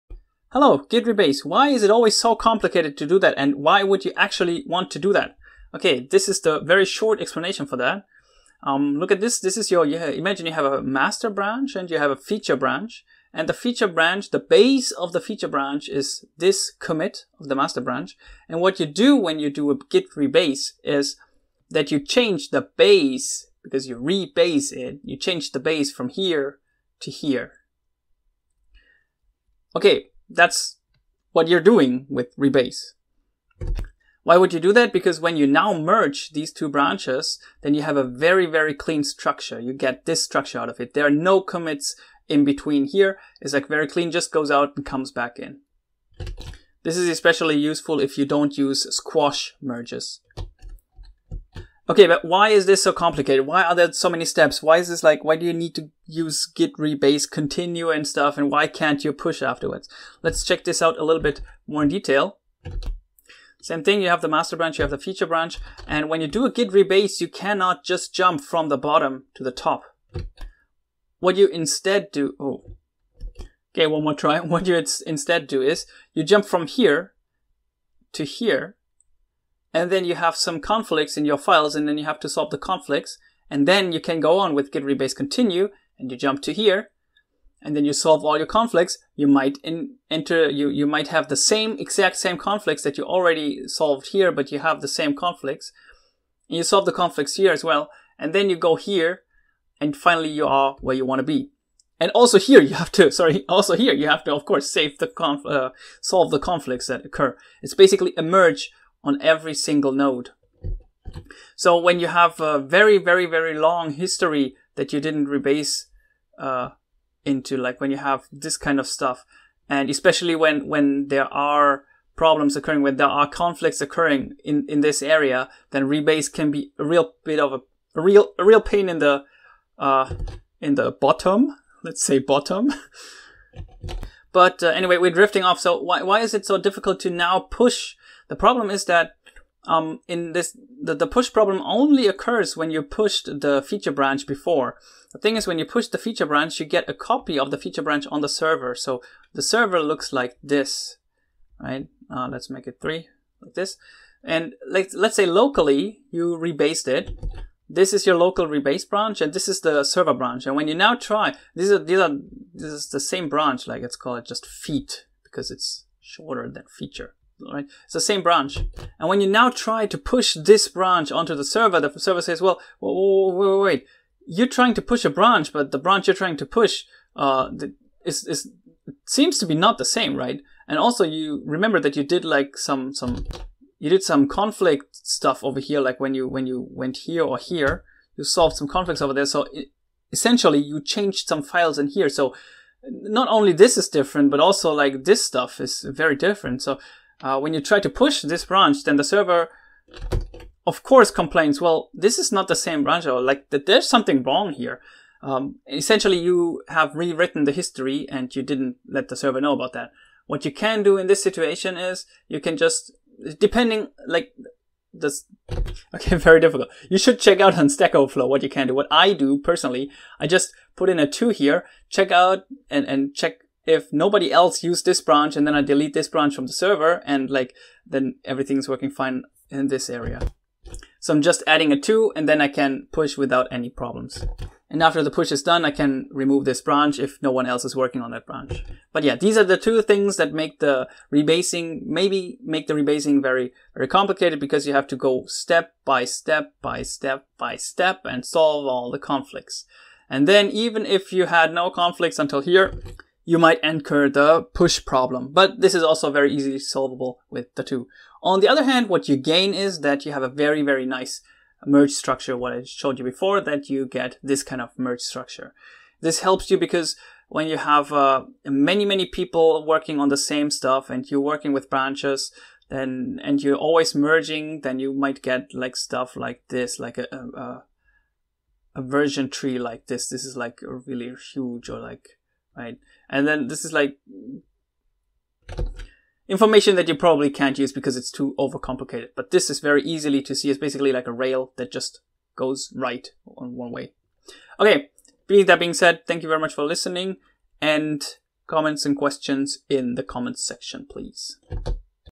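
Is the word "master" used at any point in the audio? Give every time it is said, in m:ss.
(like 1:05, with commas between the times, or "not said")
0:10, 0:17, 1:04.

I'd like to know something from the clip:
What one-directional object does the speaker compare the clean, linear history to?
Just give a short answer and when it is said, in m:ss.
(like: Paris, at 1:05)
a rail, at 4:51.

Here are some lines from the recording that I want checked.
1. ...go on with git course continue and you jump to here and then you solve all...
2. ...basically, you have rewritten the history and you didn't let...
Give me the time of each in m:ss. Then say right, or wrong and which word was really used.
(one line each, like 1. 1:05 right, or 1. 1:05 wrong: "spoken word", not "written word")
1. 1:24 wrong: "rebase", not "course"
2. 3:25 wrong: "essentially", not "basically".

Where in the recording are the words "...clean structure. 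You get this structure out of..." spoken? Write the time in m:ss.
0:38.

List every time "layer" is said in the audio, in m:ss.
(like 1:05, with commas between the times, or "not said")
not said.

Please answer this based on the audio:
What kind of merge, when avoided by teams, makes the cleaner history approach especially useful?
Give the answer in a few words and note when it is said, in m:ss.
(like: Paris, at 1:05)
squash merges, at 0:48.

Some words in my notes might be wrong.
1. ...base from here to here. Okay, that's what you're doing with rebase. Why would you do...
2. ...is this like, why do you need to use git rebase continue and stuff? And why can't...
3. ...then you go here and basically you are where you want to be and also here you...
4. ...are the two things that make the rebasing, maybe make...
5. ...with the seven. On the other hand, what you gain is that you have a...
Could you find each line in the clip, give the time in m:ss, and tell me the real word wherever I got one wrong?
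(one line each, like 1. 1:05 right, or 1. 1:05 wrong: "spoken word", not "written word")
1. 0:25 right
2. 0:54 right
3. 1:38 wrong: "finally", not "basically"
4. 3:59 right
5. 4:17 wrong: "two", not "seven".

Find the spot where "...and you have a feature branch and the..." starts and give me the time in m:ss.
0:11.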